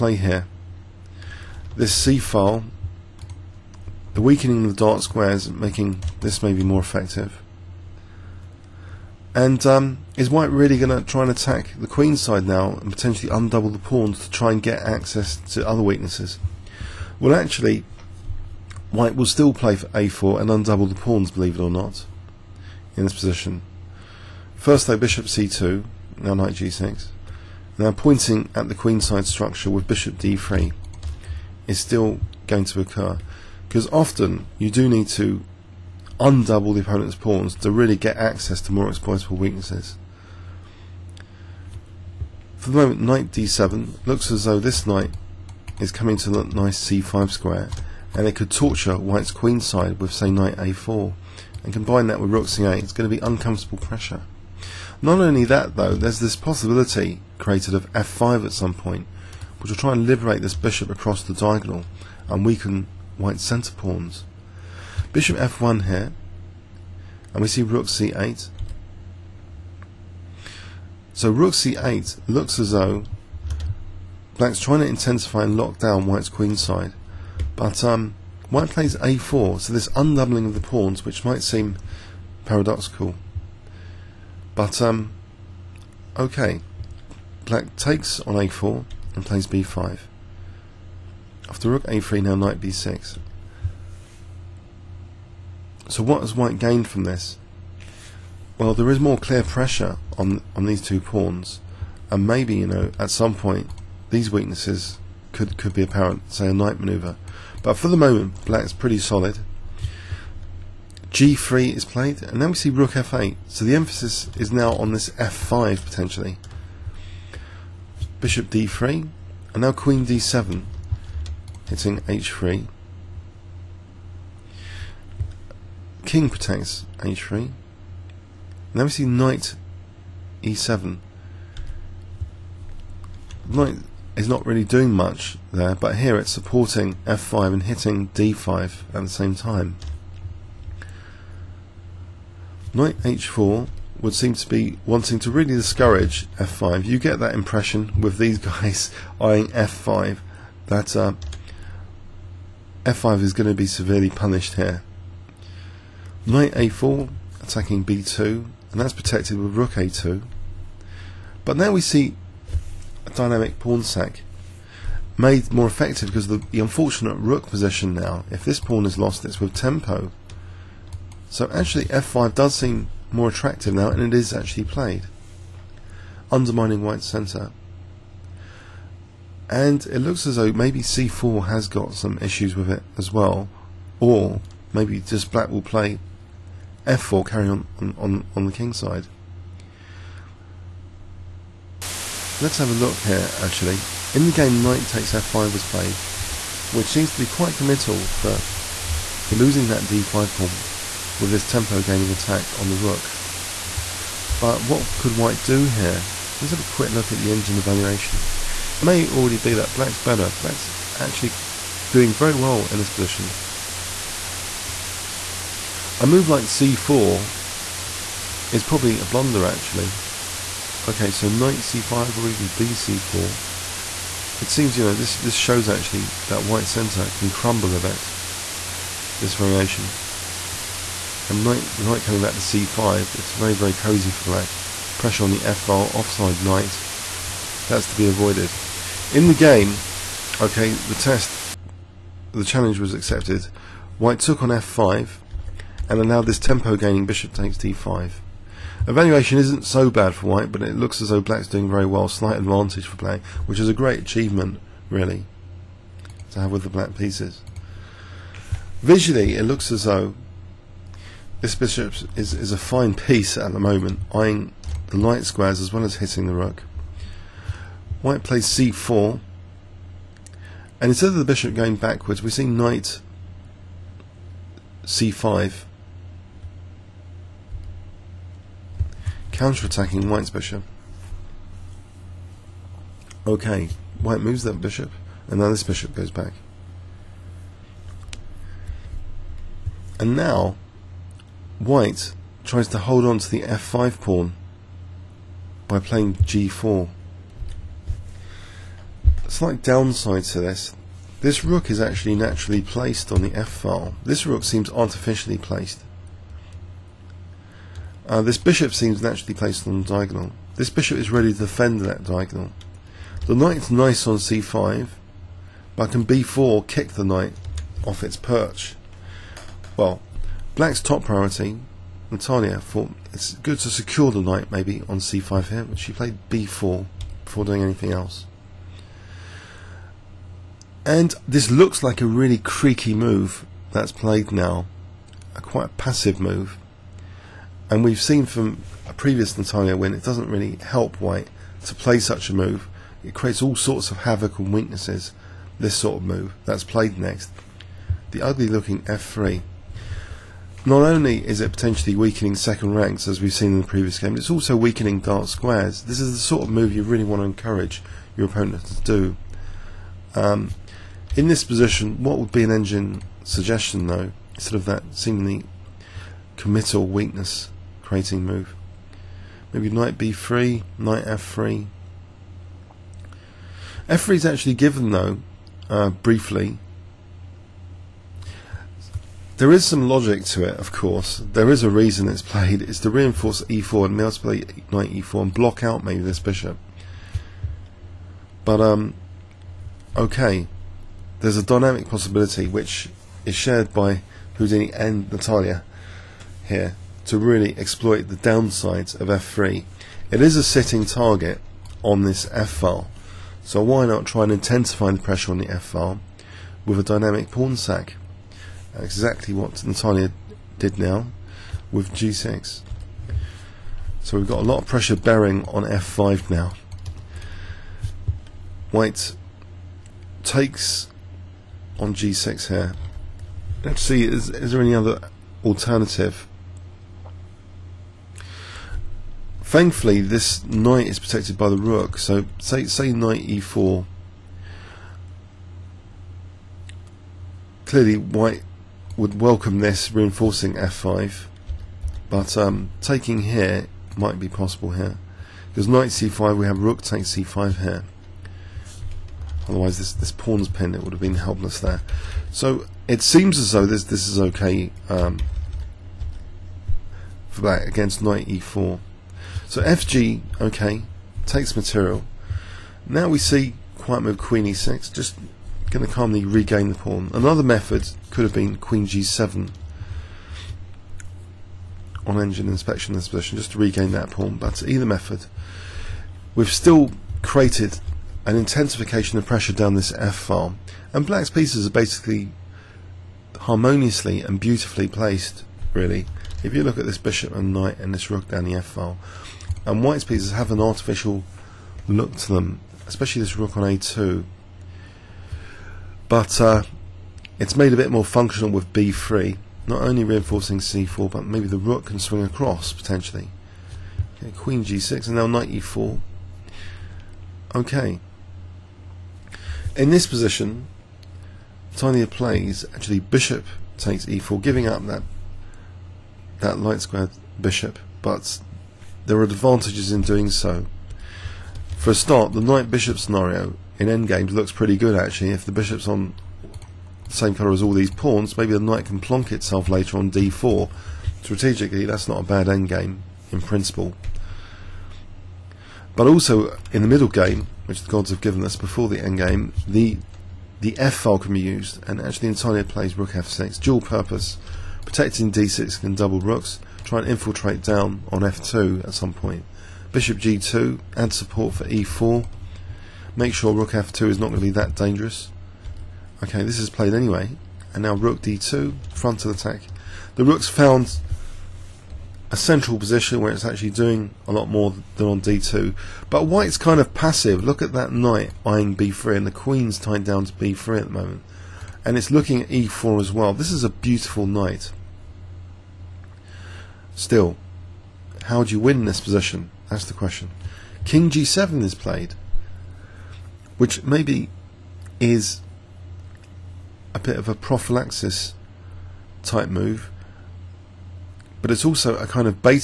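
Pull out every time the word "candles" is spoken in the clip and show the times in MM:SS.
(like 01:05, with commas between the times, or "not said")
not said.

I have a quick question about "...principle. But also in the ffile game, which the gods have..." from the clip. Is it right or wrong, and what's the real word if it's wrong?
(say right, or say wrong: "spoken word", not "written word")
wrong: "middle", not "ffile".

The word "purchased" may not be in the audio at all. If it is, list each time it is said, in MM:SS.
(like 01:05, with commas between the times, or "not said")
not said.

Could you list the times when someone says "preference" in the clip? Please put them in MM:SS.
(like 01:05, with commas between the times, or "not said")
not said.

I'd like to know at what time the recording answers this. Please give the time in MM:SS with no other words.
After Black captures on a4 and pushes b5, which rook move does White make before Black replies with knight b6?
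01:31.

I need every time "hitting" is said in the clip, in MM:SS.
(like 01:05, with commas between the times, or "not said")
02:01, 02:17, 04:25.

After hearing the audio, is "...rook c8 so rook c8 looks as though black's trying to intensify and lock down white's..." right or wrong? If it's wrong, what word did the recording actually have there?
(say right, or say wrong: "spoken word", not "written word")
right.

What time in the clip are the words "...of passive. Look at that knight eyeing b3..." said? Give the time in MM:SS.
09:26.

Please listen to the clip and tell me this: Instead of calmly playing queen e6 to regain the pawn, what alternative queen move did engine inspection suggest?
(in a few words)
Queen g7.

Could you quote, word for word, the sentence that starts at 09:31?
And it's looking at e4 as well.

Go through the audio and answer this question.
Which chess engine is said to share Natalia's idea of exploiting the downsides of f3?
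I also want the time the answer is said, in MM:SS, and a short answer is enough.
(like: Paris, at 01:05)
Houdini, at 06:34.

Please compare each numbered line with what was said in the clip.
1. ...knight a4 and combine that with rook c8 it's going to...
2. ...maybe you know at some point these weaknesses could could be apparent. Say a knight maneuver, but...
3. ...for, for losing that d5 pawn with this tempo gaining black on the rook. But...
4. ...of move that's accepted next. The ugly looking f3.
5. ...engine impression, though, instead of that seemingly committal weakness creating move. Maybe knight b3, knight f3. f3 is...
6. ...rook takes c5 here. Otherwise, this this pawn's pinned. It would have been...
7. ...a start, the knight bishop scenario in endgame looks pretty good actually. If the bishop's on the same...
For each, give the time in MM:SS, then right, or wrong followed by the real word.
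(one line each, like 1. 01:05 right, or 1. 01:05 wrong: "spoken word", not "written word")
1. 00:50 right
2. 01:42 right
3. 03:18 wrong: "attack", not "black"
4. 05:45 wrong: "played", not "accepted"
5. 06:02 wrong: "suggestion", not "impression"
6. 07:26 right
7. 08:41 right.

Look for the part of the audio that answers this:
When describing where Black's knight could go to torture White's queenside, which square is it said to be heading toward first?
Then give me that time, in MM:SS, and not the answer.
00:46.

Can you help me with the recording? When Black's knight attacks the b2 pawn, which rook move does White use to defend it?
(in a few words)
Rook a2.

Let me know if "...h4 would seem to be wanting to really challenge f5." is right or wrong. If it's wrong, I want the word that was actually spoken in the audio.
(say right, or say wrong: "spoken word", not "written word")
wrong: "discourage", not "challenge".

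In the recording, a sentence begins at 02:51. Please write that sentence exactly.
So actually f5 does seem more attractive now and it is actually played, undermining white's centre.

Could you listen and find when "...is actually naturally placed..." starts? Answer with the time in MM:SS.
05:01.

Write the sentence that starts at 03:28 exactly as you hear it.
It may already be that black's better.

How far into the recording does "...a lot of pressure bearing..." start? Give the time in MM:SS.
06:54.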